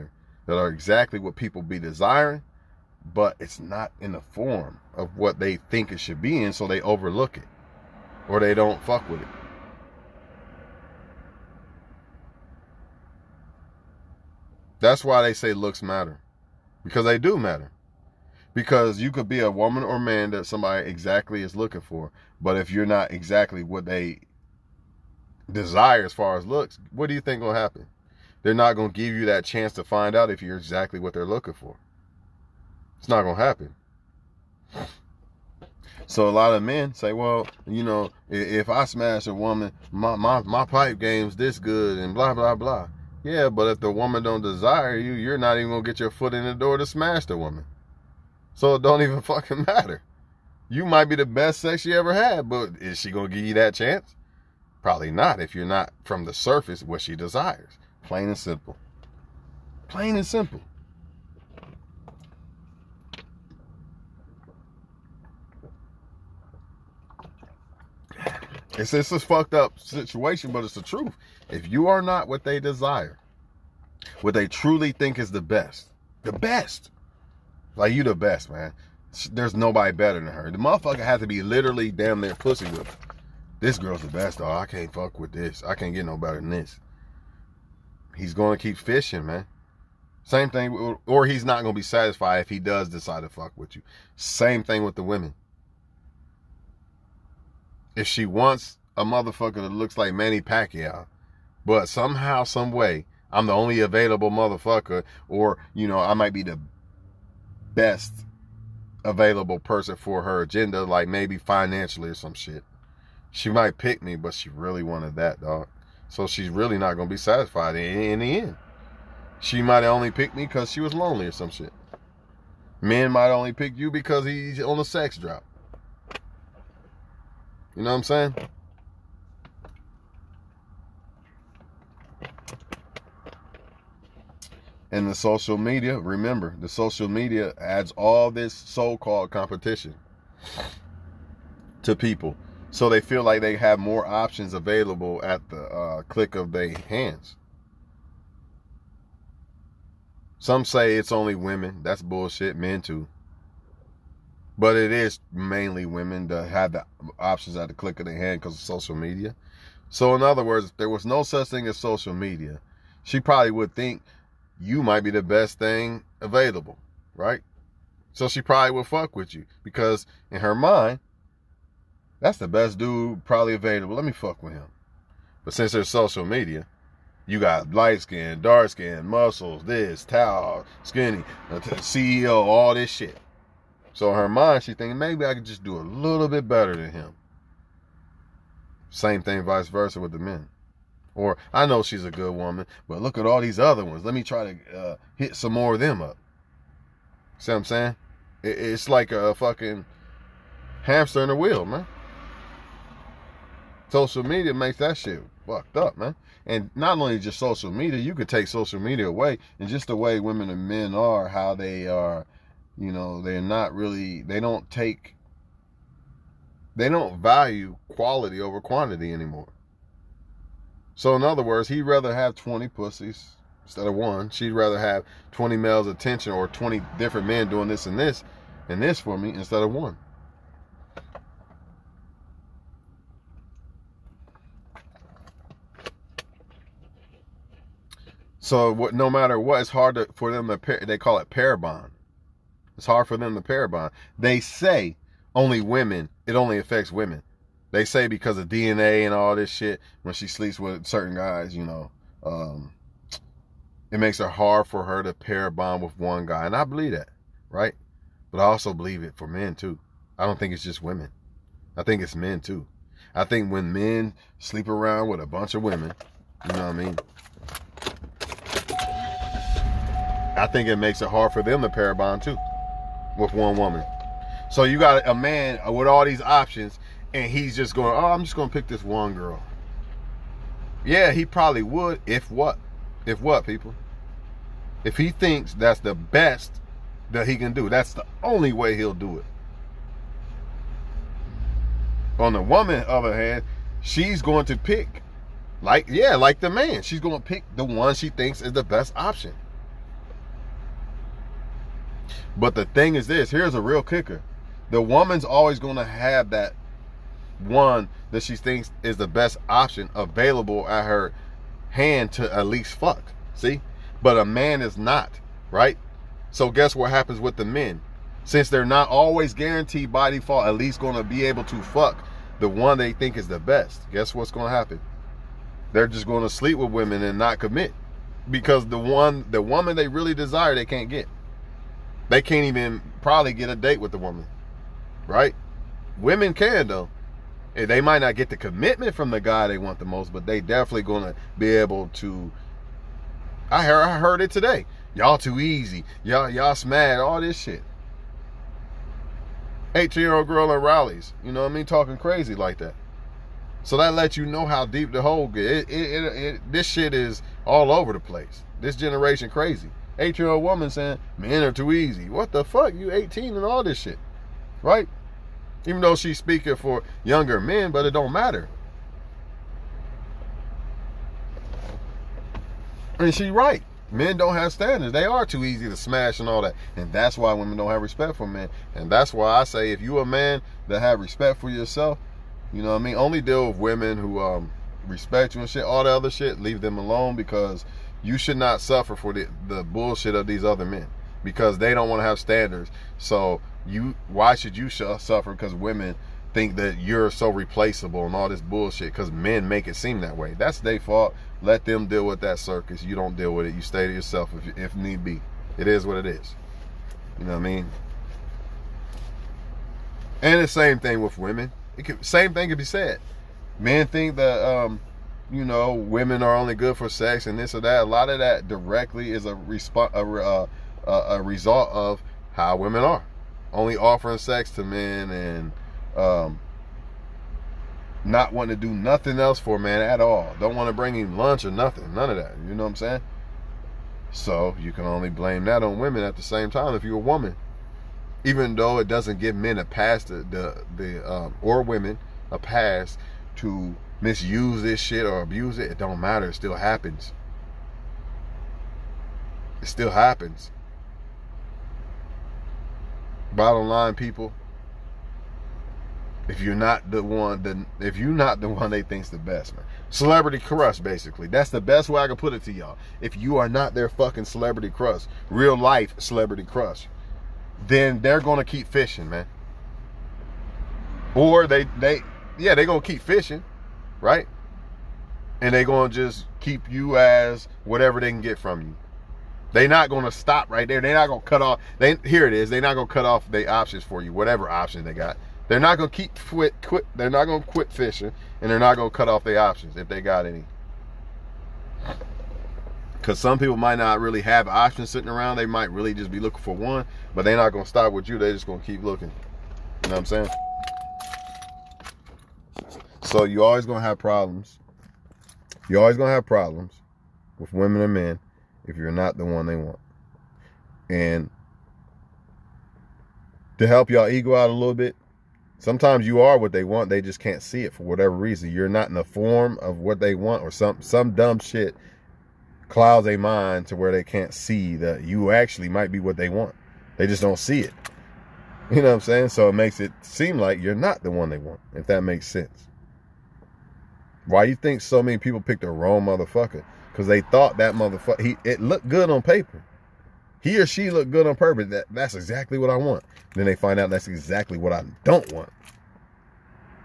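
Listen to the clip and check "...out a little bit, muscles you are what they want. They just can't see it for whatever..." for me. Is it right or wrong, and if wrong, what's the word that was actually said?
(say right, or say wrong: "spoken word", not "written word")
wrong: "sometimes", not "muscles".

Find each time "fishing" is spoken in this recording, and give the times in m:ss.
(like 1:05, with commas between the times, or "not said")
1:28, 7:48, 7:53, 8:07.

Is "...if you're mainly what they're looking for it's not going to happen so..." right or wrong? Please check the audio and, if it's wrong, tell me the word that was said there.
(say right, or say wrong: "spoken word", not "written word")
wrong: "exactly", not "mainly".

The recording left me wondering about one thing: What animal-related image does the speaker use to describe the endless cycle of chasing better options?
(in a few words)
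hamster in a wheel.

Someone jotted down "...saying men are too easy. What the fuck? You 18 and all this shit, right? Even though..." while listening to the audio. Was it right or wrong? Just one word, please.
right.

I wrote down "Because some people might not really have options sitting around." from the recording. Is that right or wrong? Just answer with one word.
right.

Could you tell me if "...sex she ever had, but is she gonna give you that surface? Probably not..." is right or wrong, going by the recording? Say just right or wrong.
wrong.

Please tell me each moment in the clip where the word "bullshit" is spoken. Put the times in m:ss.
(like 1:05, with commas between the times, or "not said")
2:32, 6:29, 6:38.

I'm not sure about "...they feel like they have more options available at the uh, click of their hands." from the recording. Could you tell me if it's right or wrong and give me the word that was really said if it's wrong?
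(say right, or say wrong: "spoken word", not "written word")
right.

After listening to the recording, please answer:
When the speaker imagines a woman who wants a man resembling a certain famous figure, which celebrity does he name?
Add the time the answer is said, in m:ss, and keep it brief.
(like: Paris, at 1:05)
Manny Pacquiao, at 1:40.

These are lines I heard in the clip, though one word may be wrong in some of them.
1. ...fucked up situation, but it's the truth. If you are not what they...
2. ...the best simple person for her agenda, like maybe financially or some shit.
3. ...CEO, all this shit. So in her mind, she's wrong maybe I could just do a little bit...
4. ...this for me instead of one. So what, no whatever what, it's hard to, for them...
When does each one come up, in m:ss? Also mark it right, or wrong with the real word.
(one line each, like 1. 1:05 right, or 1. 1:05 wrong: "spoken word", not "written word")
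1. 1:09 right
2. 1:46 wrong: "available", not "simple"
3. 3:01 wrong: "thinking", not "wrong"
4. 3:48 wrong: "matter", not "whatever".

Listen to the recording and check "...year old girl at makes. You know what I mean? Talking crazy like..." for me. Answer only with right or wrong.
wrong.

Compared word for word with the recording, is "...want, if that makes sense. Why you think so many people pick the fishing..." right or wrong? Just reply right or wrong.
wrong.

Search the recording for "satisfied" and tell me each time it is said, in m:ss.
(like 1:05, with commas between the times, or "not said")
1:31, 1:57.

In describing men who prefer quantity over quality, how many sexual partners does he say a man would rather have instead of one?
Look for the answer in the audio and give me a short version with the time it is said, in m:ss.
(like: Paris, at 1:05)
20, at 3:42.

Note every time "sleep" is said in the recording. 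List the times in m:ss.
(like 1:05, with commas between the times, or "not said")
4:10, 4:24, 5:26.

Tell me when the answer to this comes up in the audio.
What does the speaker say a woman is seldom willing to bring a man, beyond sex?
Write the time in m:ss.
7:11.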